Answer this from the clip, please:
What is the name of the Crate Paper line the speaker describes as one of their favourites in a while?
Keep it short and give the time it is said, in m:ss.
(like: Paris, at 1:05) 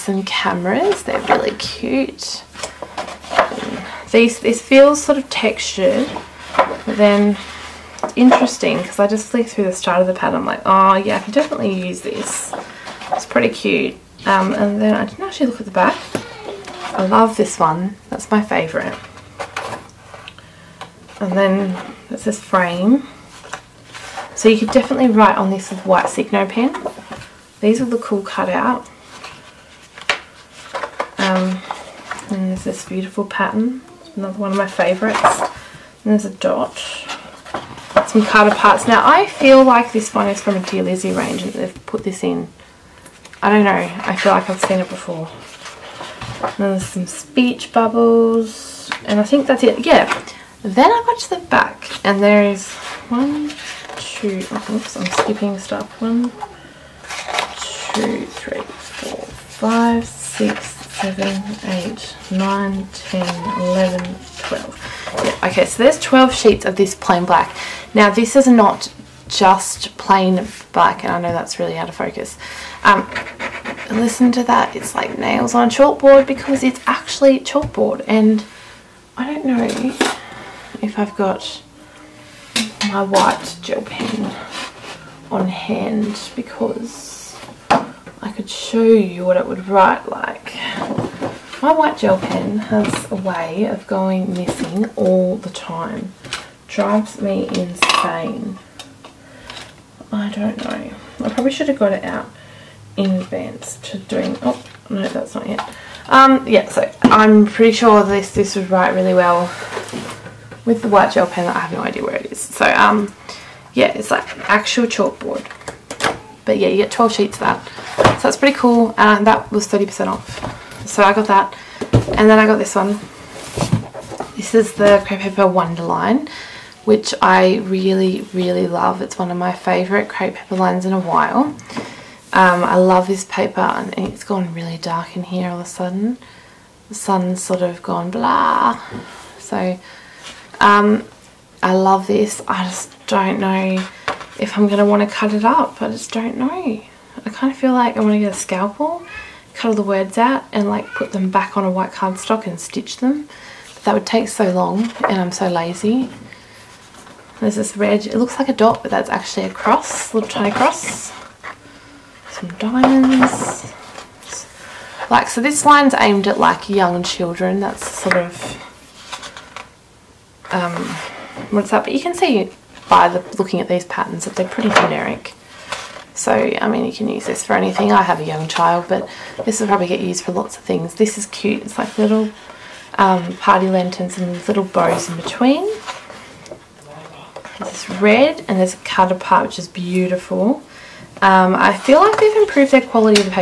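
Wonder, at 2:05.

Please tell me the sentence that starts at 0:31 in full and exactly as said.
Um, and there's this beautiful pattern.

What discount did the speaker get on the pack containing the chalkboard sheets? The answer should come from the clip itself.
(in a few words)
30%.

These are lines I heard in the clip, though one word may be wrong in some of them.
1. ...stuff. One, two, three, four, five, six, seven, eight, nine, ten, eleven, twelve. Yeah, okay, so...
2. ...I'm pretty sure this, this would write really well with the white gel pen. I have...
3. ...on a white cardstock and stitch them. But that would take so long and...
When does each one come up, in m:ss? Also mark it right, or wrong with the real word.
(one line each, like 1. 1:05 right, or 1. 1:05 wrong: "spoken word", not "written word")
1. 0:55 right
2. 1:47 right
3. 2:31 right.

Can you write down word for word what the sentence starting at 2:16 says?
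The sun's sort of gone blah.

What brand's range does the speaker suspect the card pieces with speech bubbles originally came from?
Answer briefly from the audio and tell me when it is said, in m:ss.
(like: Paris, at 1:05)
Dear Lizzie, at 0:40.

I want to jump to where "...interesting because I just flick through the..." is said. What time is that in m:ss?
0:08.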